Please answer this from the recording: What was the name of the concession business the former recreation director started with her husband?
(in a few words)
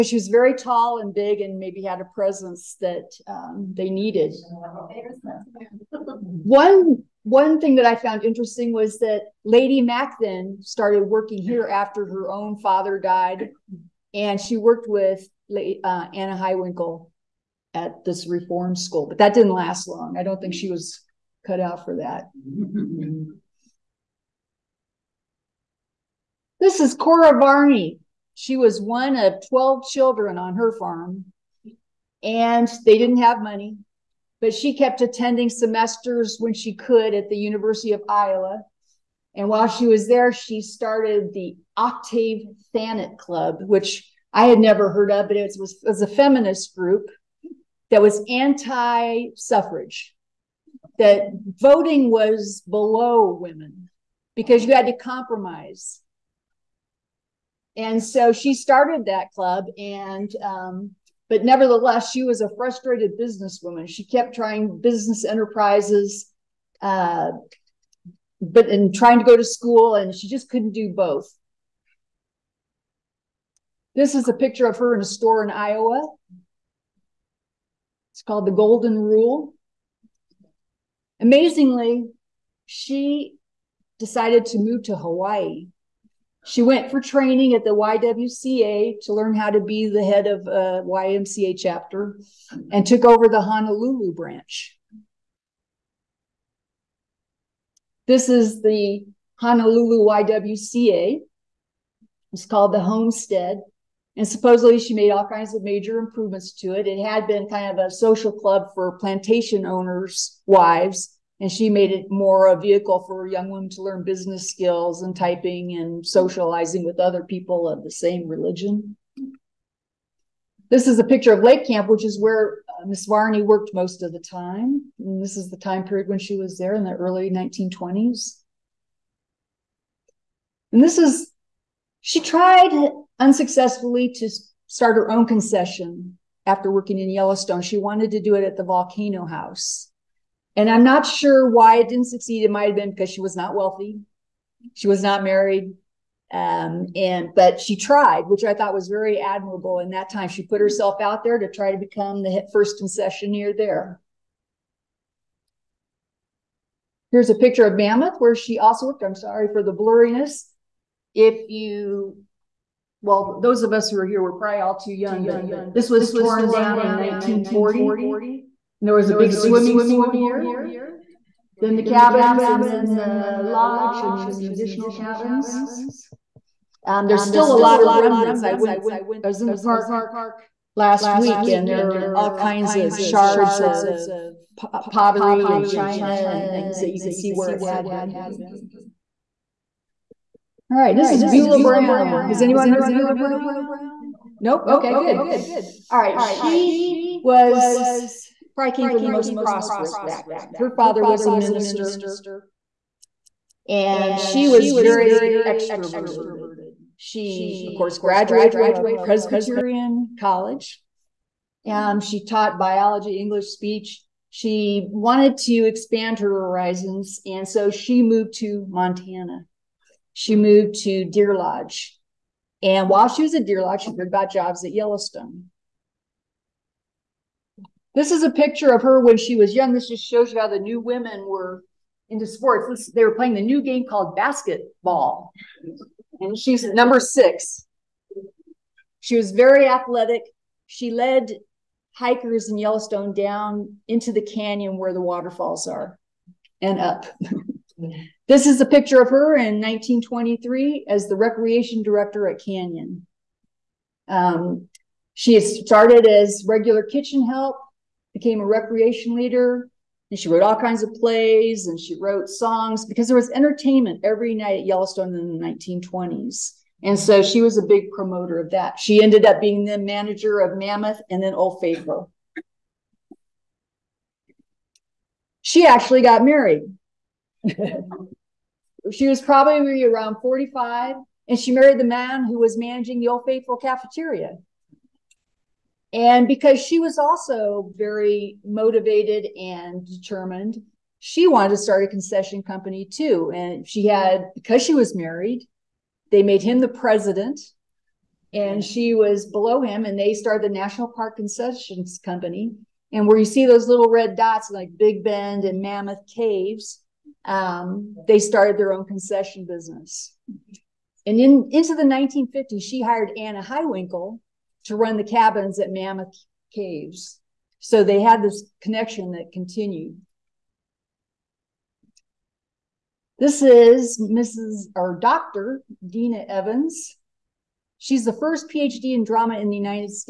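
National Park Concessions Company.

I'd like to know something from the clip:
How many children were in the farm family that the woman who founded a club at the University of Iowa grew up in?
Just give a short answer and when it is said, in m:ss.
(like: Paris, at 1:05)
12, at 0:29.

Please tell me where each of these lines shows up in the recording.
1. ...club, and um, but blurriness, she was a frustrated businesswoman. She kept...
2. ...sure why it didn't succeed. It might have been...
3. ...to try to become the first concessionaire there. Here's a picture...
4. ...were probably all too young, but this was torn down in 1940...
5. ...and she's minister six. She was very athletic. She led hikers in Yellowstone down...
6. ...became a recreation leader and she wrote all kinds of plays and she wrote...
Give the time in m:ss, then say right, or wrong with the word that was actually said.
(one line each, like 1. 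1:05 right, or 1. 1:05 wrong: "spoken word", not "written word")
1. 0:59 wrong: "nevertheless", not "blurriness"
2. 2:21 right
3. 2:31 right
4. 2:44 right
5. 3:56 wrong: "number", not "minister"
6. 4:18 right.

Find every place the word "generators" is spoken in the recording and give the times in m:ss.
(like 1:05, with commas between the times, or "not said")
not said.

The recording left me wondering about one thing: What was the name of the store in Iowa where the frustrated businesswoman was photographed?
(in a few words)
Golden Rule.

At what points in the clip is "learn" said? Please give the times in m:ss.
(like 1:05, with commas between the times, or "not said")
1:29, 1:53.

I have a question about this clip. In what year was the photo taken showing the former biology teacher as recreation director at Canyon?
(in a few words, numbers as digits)
1923.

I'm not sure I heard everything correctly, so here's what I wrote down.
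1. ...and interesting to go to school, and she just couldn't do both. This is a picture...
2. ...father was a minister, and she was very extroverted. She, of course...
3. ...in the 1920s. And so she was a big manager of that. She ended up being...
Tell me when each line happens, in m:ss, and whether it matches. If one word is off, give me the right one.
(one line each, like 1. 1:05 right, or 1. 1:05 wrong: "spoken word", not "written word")
1. 1:08 wrong: "trying", not "interesting"
2. 3:20 right
3. 4:25 wrong: "promoter", not "manager".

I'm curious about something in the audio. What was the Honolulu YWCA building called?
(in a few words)
The Homestead.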